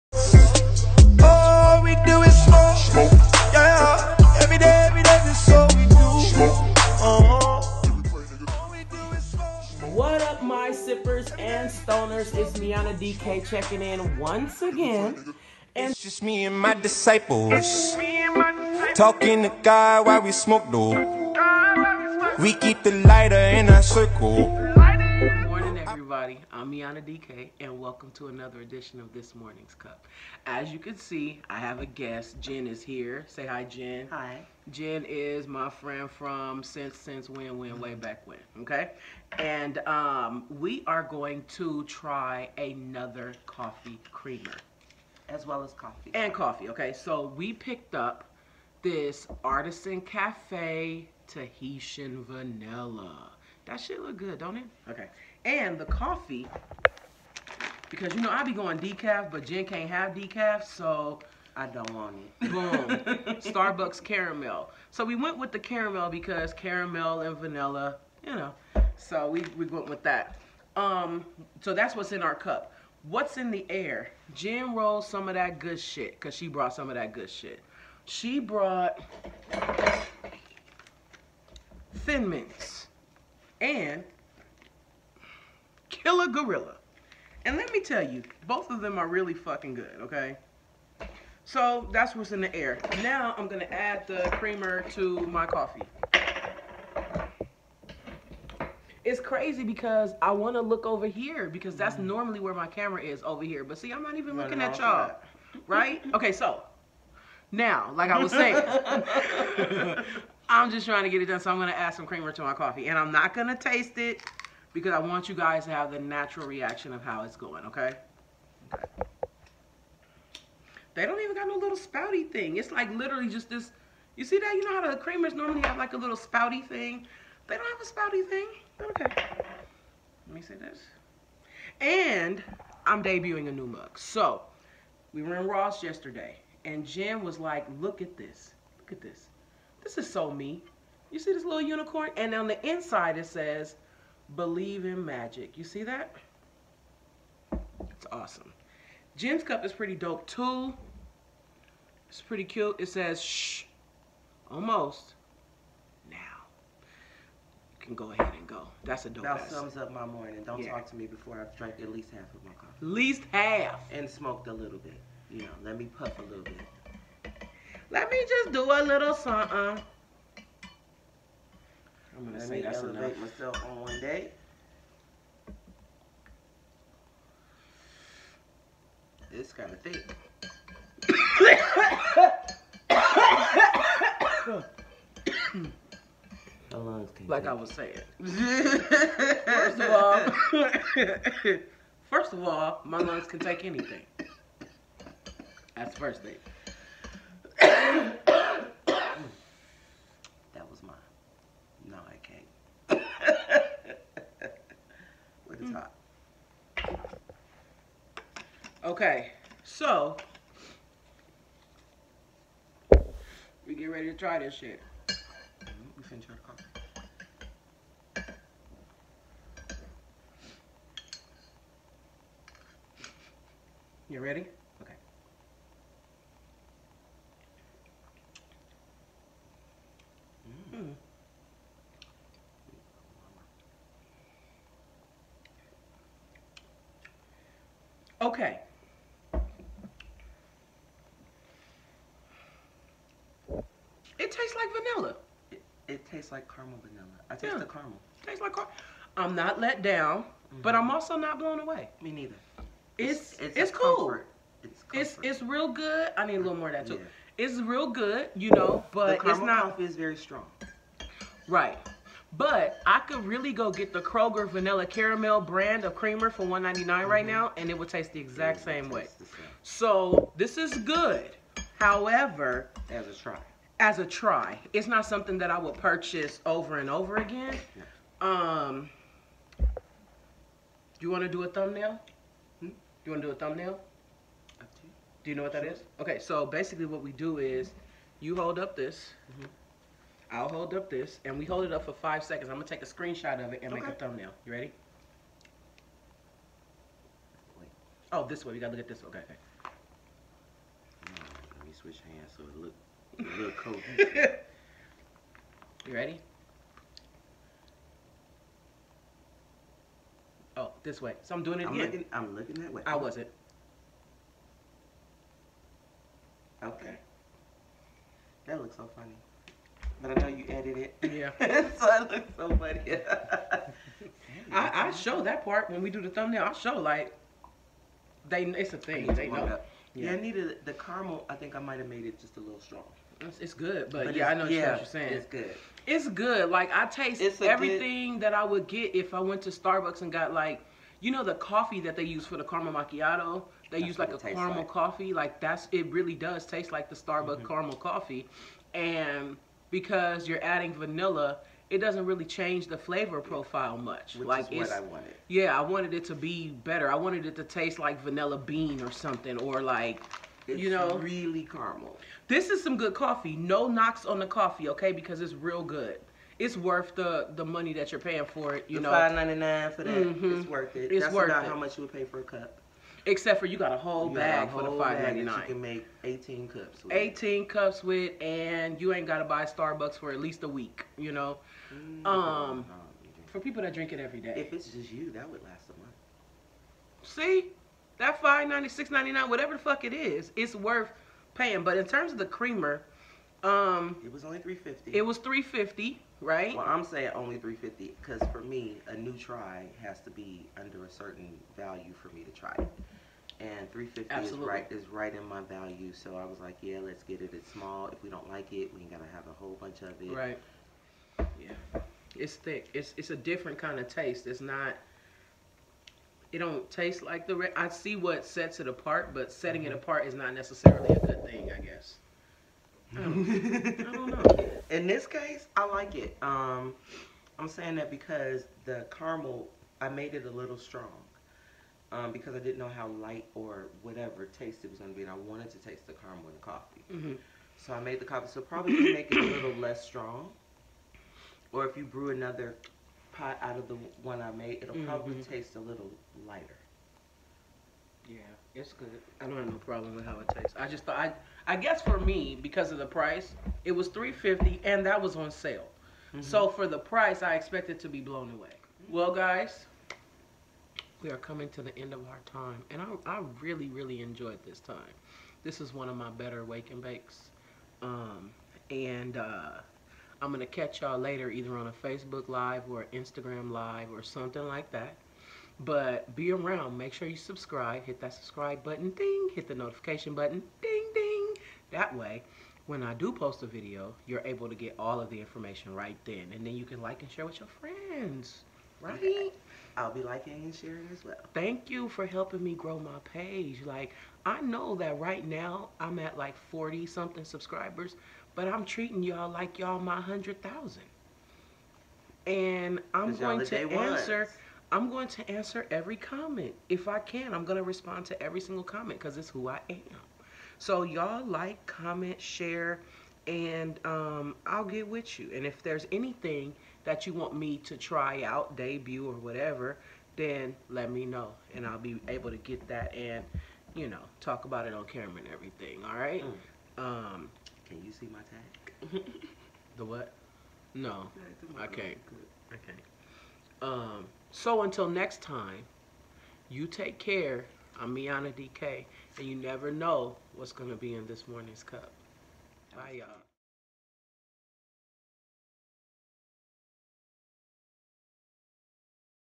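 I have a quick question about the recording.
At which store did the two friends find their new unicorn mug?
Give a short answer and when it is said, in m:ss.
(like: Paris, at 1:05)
Ross, at 2:15.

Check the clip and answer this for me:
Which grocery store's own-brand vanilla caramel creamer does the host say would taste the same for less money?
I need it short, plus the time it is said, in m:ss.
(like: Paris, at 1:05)
Kroger, at 4:24.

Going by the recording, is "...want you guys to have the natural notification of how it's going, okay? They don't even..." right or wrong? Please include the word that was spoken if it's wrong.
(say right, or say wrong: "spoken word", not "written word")
wrong: "reaction", not "notification".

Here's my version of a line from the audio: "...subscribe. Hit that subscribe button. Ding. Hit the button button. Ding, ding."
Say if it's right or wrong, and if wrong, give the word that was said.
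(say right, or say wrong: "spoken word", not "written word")
wrong: "notification", not "button".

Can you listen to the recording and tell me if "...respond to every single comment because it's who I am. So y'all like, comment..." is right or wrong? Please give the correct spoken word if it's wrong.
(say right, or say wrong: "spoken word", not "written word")
right.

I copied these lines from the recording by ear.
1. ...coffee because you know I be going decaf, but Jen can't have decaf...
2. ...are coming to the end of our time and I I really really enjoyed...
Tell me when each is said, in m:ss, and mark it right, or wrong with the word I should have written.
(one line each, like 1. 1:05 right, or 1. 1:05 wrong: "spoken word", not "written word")
1. 0:55 right
2. 7:41 right.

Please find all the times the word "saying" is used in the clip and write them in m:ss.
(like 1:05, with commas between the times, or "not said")
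1:48, 3:07, 5:34, 6:36, 7:07.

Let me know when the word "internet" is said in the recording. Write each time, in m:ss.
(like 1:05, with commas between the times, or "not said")
not said.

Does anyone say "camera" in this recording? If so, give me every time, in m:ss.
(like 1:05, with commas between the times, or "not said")
1:42, 8:44.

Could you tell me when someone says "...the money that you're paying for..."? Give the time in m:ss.
6:07.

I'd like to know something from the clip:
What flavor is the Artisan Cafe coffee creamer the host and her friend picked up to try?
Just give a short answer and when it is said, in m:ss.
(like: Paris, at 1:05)
Tahitian Vanilla, at 0:51.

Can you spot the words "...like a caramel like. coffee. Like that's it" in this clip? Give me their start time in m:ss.
5:43.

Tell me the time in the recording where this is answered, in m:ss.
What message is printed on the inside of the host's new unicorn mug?
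2:24.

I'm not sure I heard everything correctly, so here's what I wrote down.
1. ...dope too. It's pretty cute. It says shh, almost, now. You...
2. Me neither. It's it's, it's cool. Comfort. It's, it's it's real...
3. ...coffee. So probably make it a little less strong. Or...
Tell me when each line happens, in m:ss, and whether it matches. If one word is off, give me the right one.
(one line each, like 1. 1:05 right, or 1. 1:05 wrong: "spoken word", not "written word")
1. 2:29 right
2. 4:12 right
3. 7:18 right.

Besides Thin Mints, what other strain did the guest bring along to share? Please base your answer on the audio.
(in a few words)
Killer Gorilla.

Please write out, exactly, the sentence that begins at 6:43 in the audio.
And 350 is right is right in my value, so I was like, yeah, let's get it.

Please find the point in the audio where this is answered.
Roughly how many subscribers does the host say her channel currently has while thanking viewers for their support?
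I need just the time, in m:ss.
8:16.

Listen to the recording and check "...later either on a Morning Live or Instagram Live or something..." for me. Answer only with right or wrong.
wrong.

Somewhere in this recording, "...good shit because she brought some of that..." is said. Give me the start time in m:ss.
1:15.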